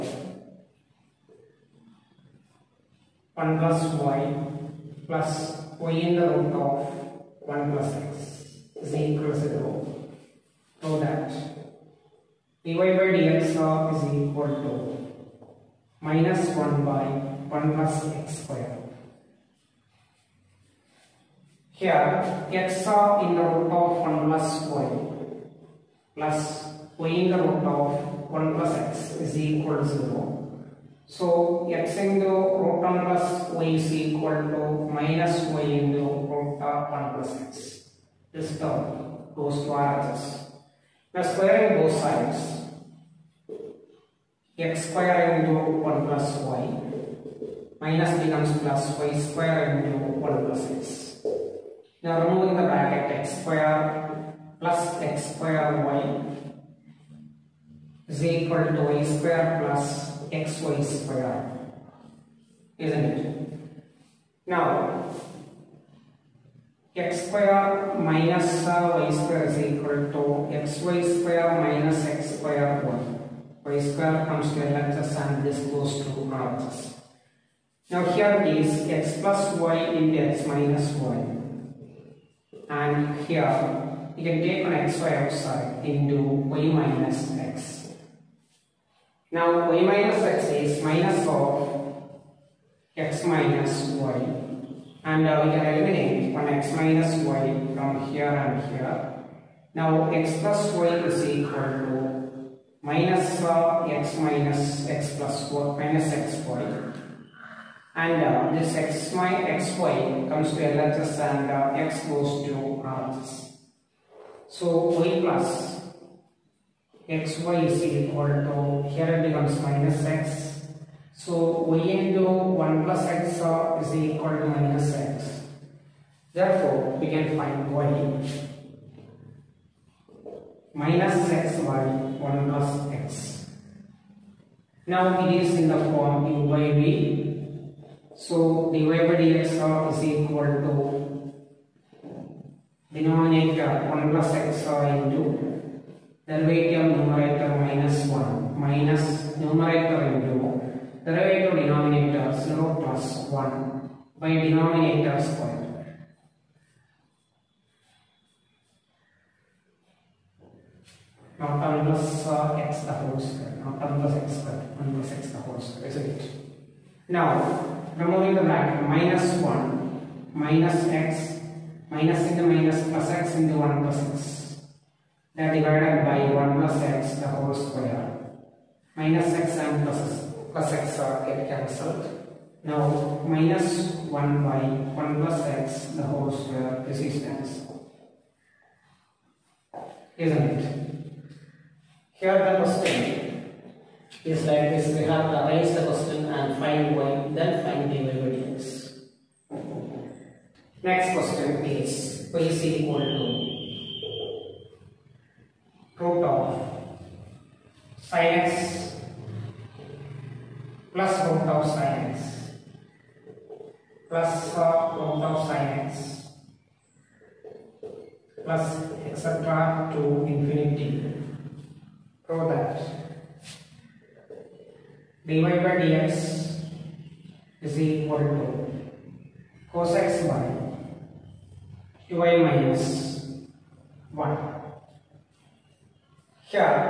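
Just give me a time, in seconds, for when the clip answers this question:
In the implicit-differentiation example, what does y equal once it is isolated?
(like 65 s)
130 s.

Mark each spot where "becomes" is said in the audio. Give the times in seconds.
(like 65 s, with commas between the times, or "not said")
48 s, 119 s.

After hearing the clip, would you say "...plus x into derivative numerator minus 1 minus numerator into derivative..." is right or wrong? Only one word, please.
right.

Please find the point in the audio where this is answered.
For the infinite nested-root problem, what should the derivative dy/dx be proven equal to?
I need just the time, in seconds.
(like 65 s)
229 s.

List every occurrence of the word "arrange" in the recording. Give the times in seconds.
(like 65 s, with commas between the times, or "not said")
195 s.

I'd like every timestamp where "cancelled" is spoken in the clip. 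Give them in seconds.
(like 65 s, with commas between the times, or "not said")
181 s, 187 s.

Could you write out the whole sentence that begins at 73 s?
y square comes to LHS and this goes to RHS.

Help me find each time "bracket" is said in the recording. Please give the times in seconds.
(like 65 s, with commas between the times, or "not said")
52 s, 168 s.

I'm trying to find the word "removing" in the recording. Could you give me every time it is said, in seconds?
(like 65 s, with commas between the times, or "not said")
52 s, 167 s.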